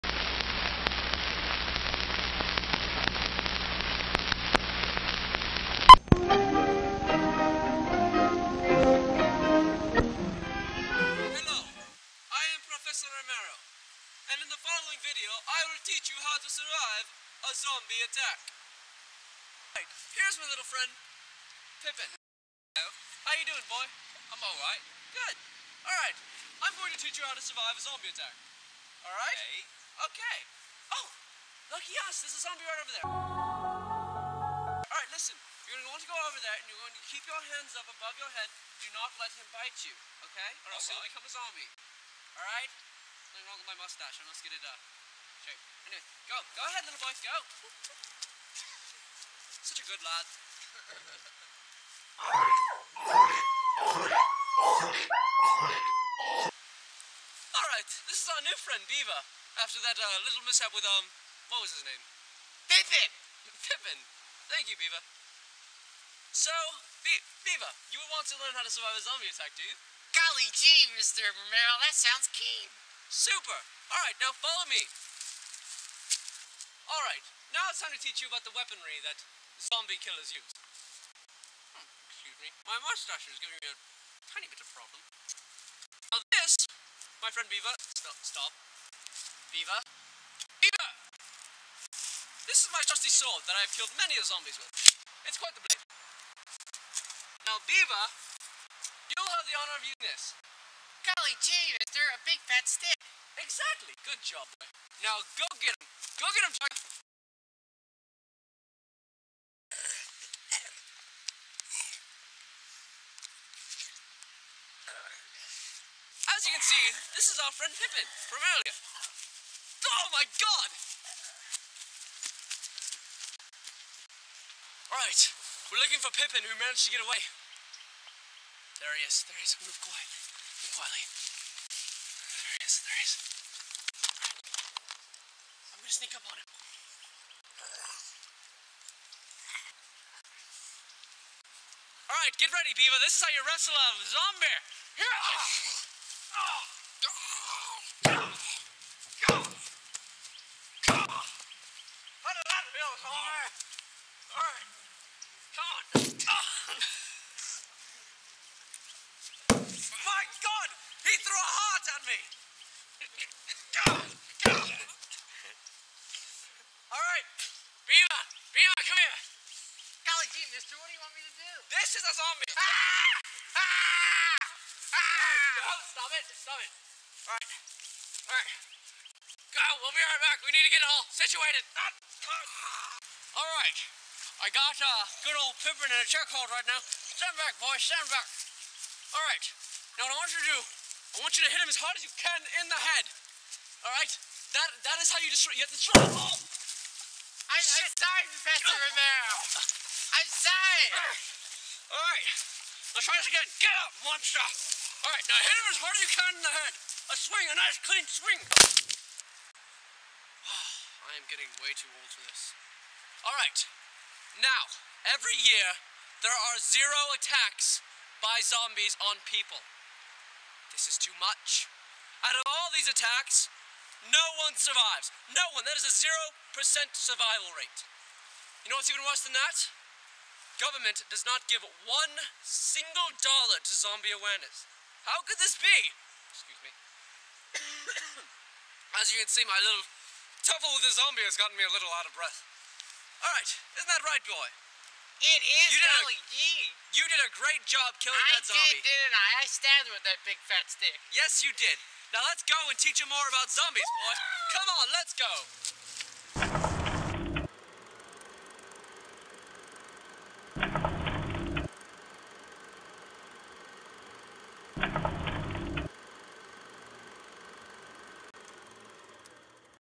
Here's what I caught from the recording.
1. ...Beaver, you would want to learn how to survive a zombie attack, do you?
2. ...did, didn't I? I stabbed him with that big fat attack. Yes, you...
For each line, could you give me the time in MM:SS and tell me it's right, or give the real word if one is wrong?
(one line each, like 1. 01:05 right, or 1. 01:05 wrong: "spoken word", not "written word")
1. 01:07 right
2. 04:08 wrong: "stick", not "attack".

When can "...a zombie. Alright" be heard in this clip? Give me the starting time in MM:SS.
00:41.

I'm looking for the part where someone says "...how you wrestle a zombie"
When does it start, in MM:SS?
02:23.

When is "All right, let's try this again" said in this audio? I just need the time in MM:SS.
03:21.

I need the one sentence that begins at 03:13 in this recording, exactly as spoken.
All right, that that is how you destroy.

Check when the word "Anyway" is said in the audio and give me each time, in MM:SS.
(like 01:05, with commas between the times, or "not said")
00:45.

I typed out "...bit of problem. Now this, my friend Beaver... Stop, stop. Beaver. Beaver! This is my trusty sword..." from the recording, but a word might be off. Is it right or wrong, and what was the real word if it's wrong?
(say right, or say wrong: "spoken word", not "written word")
right.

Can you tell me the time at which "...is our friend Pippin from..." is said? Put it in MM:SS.
01:57.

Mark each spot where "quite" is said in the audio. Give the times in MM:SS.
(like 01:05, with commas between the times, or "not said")
01:35.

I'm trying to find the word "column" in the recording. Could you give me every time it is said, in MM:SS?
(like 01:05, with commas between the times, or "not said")
not said.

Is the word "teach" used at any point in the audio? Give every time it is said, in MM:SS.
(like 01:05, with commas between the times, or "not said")
00:26, 01:17, 04:12.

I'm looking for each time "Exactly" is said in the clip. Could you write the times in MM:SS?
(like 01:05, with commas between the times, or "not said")
01:43.